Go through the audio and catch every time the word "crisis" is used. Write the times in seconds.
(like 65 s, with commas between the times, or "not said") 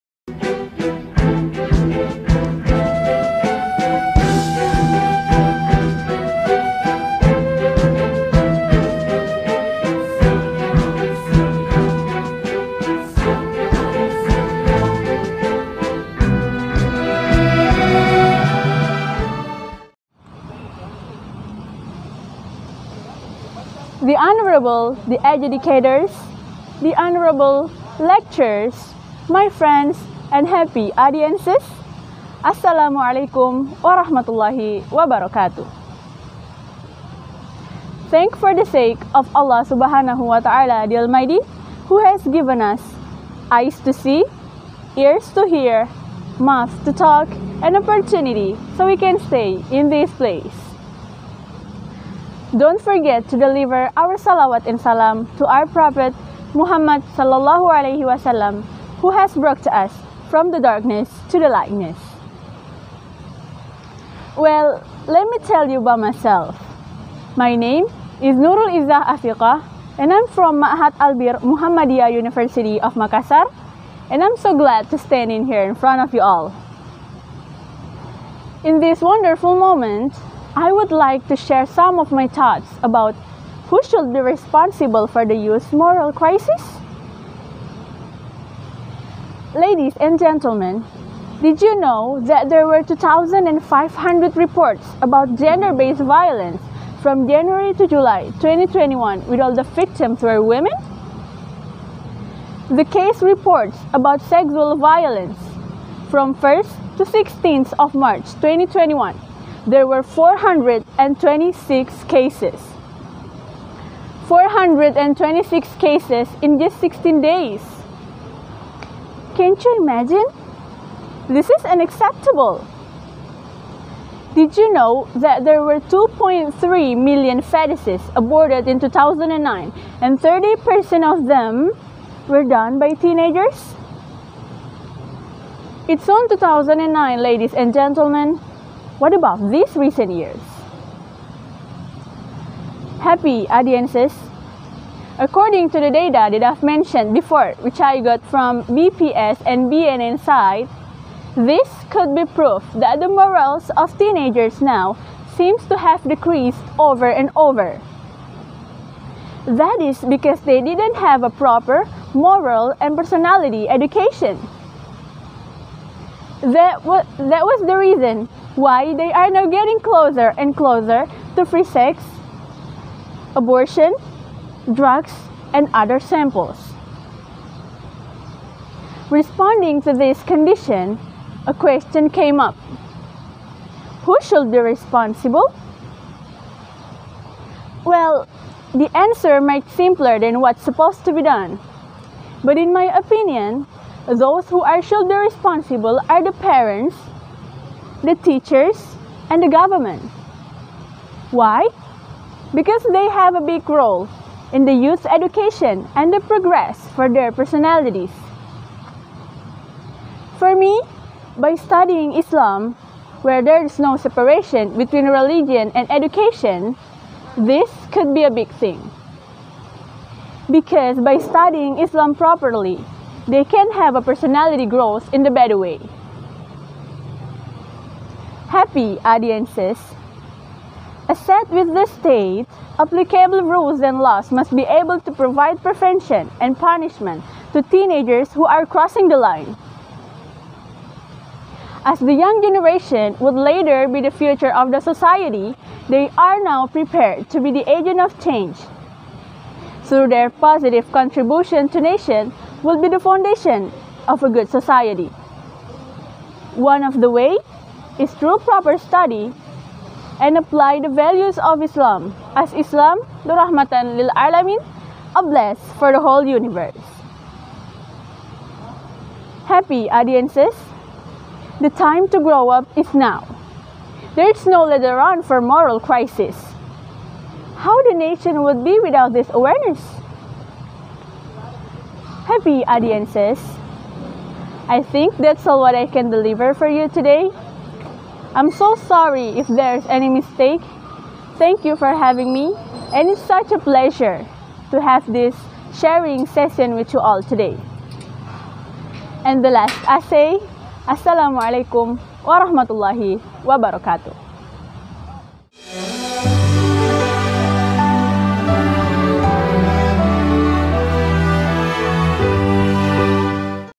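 86 s, 275 s.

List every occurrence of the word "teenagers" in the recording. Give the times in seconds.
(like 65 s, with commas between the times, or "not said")
132 s, 153 s, 237 s.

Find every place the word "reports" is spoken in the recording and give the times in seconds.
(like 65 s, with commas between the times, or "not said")
94 s, 103 s.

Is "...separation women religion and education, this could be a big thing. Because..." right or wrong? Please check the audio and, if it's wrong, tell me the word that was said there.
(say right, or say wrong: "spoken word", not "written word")
wrong: "between", not "women".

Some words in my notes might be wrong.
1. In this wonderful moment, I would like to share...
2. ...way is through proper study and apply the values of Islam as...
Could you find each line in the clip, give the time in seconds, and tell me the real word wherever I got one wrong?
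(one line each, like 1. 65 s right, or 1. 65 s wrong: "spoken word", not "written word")
1. 78 s right
2. 257 s right.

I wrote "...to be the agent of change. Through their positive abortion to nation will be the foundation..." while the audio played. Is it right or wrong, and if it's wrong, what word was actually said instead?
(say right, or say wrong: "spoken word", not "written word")
wrong: "contribution", not "abortion".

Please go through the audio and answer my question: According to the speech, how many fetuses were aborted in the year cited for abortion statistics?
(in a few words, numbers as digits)
2.3 million.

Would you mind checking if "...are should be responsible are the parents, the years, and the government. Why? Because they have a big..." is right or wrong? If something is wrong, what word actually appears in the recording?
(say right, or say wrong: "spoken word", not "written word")
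wrong: "teachers", not "years".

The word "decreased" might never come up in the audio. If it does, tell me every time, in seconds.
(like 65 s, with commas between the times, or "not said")
156 s.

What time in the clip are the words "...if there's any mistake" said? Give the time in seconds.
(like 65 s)
289 s.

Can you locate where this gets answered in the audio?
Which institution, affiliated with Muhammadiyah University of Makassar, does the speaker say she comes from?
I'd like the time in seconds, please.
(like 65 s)
70 s.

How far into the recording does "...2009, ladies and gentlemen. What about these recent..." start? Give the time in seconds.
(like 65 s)
136 s.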